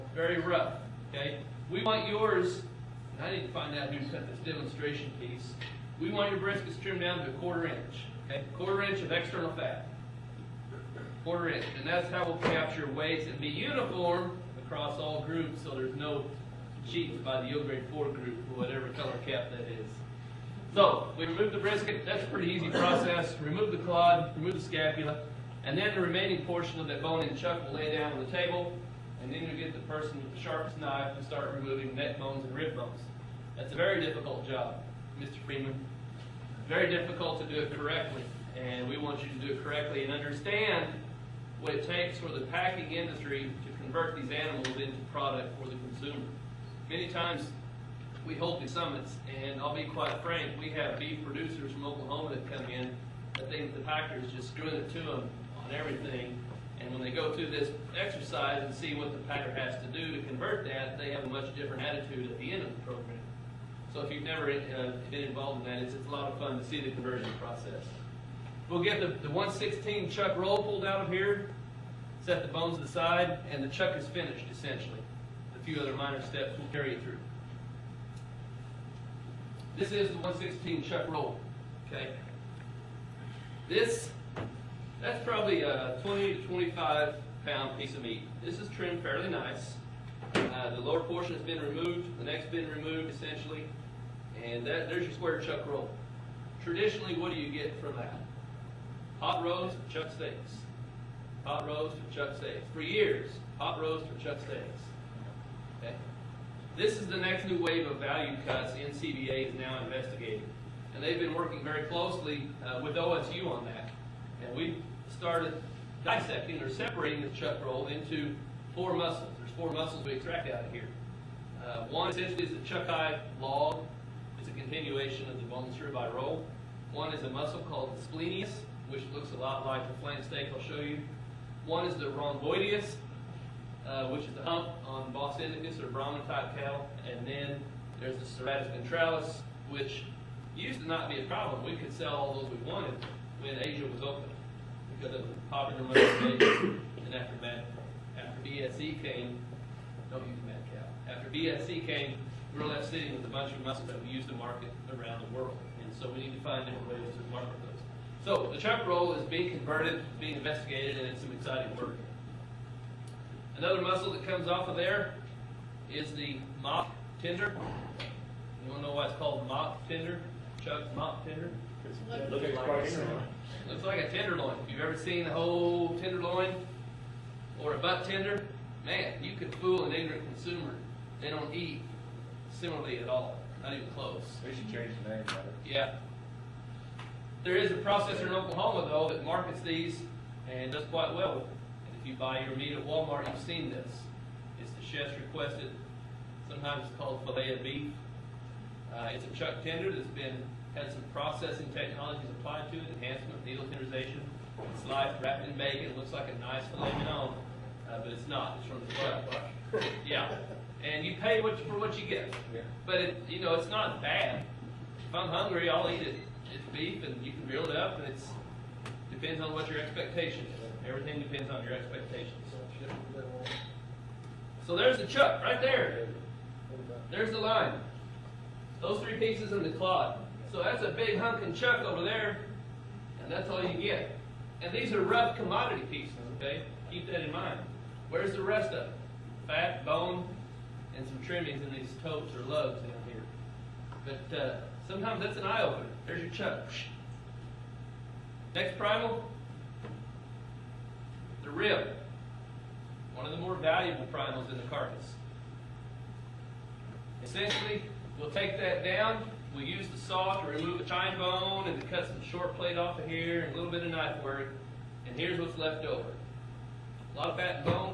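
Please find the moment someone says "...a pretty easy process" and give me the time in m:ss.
0:22.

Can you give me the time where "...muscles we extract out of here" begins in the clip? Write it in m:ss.
1:59.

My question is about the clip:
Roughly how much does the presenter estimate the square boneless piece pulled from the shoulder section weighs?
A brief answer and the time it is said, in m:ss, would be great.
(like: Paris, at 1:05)
20 to 25 pounds, at 1:26.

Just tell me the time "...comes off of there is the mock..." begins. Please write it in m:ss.
2:44.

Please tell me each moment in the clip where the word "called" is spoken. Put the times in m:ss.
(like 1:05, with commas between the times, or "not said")
2:07, 2:49, 3:16.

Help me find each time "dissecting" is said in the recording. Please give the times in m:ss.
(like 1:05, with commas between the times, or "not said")
1:56.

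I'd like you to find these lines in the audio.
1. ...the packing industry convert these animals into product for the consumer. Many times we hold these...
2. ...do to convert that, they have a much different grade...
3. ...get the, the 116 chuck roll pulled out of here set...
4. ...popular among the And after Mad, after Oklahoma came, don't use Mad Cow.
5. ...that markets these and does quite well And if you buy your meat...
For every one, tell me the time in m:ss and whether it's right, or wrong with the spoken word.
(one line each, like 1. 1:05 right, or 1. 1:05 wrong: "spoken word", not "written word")
1. 0:42 right
2. 0:59 wrong: "attitude", not "grade"
3. 1:08 right
4. 2:25 wrong: "BSE", not "Oklahoma"
5. 3:09 right.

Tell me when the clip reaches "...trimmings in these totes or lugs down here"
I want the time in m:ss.
4:01.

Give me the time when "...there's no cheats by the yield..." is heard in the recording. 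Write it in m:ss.
0:15.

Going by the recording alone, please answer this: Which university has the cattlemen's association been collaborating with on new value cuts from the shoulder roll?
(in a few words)
OSU.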